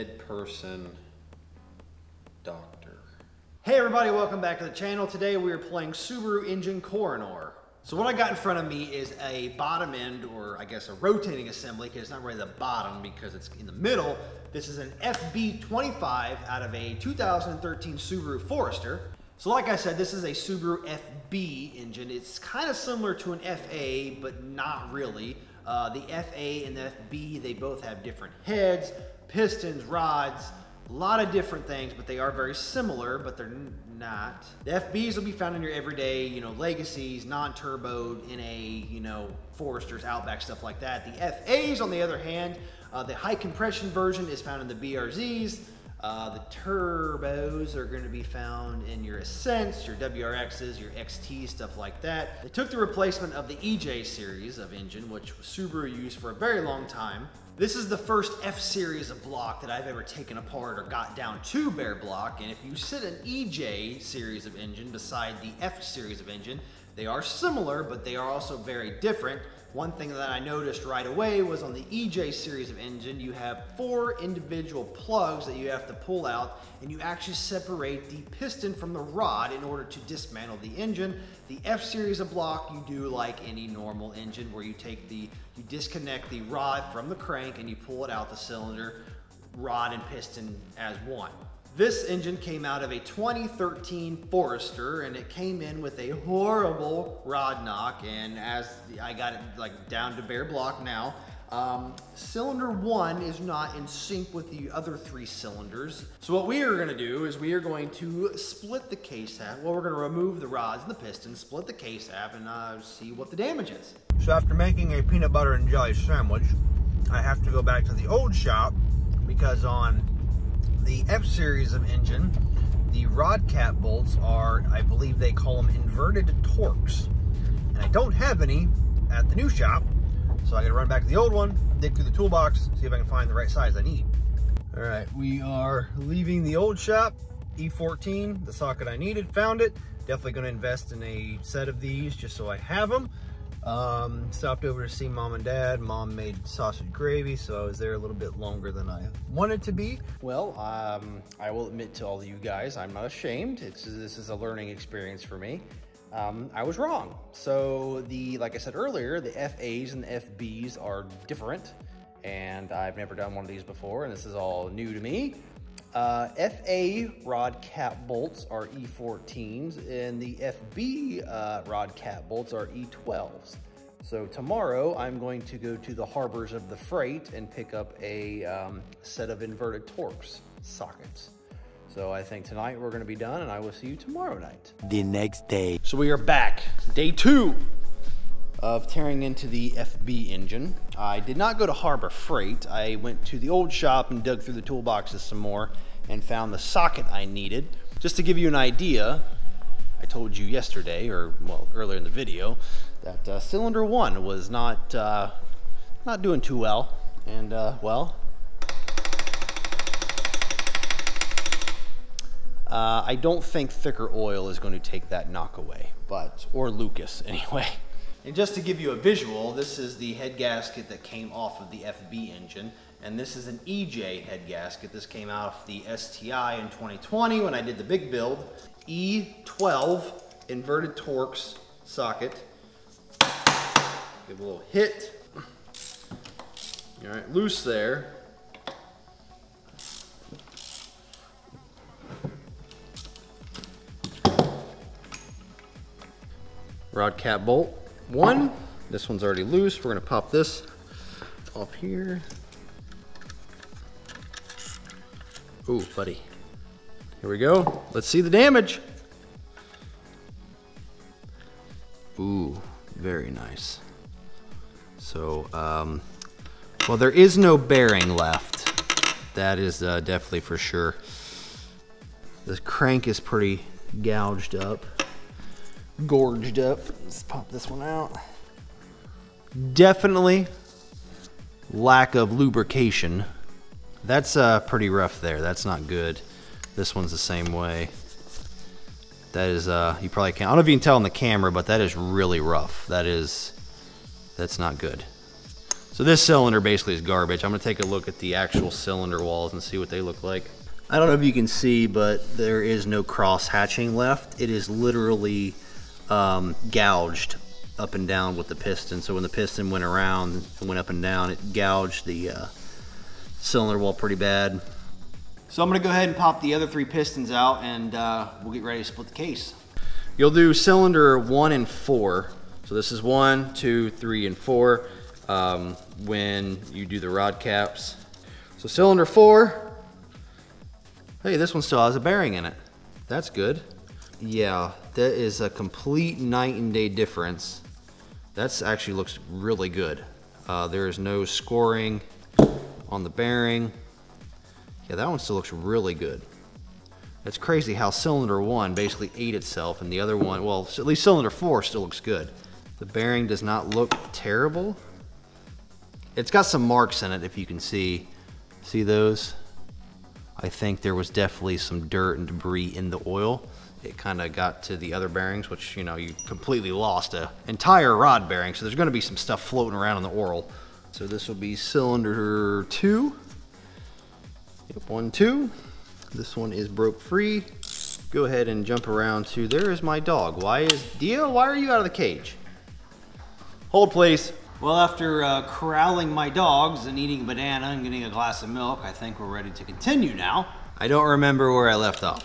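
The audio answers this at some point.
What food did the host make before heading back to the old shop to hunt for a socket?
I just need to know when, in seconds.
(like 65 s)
115 s.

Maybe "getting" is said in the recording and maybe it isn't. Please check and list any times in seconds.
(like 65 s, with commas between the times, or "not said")
387 s.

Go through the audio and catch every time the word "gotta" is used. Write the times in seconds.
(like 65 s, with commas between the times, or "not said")
130 s.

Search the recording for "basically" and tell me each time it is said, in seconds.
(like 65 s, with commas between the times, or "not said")
296 s, 348 s.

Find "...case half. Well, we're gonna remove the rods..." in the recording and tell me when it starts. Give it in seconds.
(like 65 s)
108 s.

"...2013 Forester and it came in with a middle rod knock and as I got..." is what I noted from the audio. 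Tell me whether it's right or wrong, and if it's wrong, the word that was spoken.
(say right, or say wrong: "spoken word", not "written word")
wrong: "horrible", not "middle".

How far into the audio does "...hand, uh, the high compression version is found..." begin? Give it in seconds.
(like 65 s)
42 s.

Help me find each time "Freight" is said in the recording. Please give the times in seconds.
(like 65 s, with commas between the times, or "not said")
176 s, 192 s.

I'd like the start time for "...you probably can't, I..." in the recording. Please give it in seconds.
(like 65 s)
290 s.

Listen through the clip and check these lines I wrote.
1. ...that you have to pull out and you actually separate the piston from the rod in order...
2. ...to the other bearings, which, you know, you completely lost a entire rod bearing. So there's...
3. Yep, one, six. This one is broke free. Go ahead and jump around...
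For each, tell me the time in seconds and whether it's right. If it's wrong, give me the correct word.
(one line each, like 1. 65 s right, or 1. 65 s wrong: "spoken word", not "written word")
1. 75 s right
2. 364 s right
3. 374 s wrong: "two", not "six".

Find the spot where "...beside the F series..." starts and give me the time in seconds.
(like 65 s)
64 s.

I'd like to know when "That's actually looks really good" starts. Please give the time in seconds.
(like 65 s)
338 s.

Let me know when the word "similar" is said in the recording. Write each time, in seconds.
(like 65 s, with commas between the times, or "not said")
22 s, 32 s, 67 s.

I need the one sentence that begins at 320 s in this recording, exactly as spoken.
You'll do cylinder one and four.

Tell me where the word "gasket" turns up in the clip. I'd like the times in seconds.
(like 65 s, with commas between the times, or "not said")
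220 s, 224 s.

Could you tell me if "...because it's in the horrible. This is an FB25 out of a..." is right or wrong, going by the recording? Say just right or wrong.
wrong.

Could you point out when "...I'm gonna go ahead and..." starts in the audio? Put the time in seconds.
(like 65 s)
315 s.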